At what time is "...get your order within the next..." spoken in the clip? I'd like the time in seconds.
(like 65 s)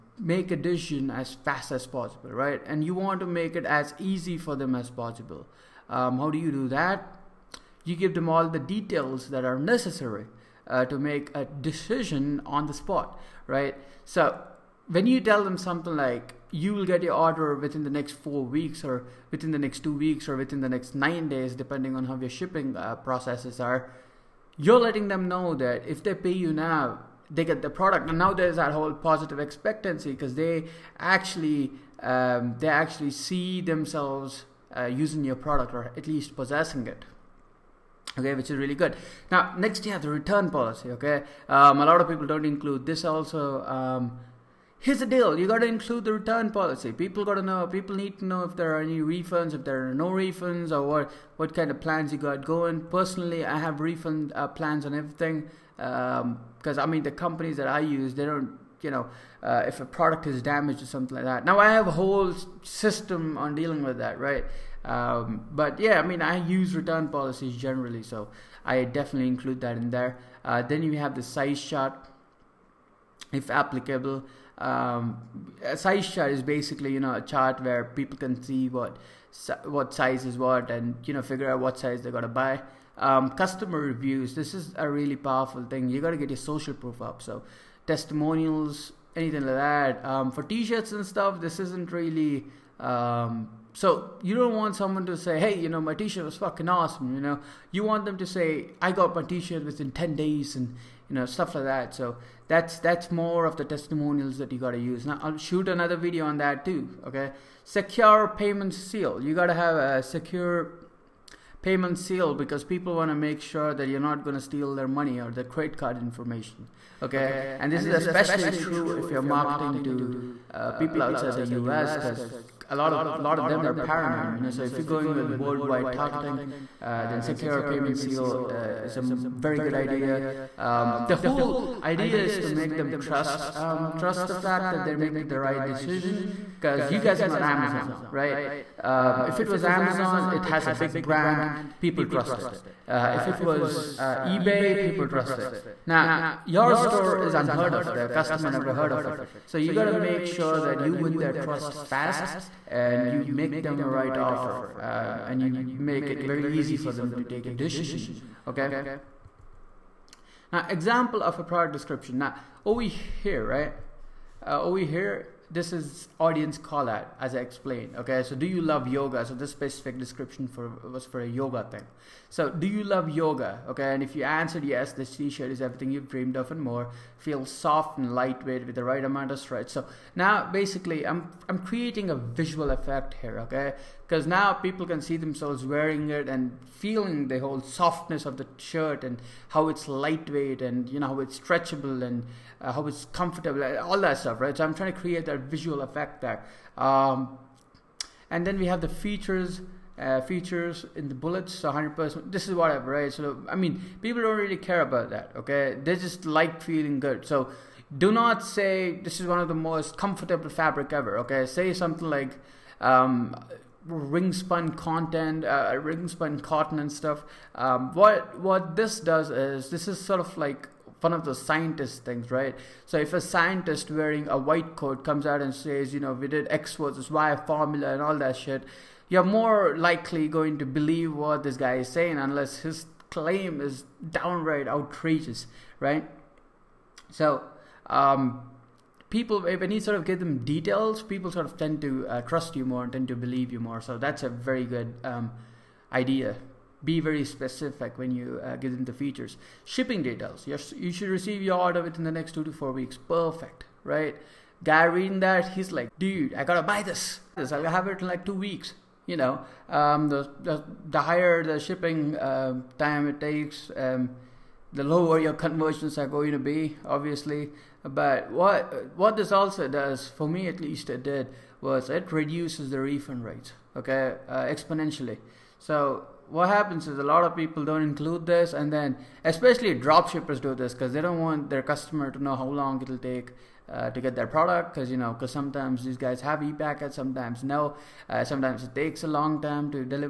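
16 s.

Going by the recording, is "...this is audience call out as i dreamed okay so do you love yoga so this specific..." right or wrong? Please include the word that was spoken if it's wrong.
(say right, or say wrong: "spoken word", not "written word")
wrong: "explained", not "dreamed".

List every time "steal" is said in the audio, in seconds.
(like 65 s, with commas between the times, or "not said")
114 s.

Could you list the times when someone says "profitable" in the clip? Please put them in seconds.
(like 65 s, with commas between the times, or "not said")
not said.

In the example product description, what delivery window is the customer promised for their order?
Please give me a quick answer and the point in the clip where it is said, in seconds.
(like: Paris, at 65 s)
2 to 4 weeks, at 252 s.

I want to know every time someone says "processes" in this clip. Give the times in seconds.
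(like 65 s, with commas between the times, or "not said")
22 s.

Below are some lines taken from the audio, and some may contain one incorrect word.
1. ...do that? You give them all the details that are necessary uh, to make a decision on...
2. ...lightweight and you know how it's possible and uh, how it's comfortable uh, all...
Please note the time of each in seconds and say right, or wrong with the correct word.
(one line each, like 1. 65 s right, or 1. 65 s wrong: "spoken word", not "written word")
1. 6 s right
2. 189 s wrong: "stretchable", not "possible".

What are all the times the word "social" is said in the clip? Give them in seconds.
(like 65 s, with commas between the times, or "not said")
86 s.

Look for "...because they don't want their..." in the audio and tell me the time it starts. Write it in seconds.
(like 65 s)
280 s.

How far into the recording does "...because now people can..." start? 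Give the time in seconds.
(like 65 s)
184 s.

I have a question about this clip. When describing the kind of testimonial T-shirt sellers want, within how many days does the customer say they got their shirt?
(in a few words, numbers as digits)
10 days.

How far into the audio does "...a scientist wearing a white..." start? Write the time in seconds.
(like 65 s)
223 s.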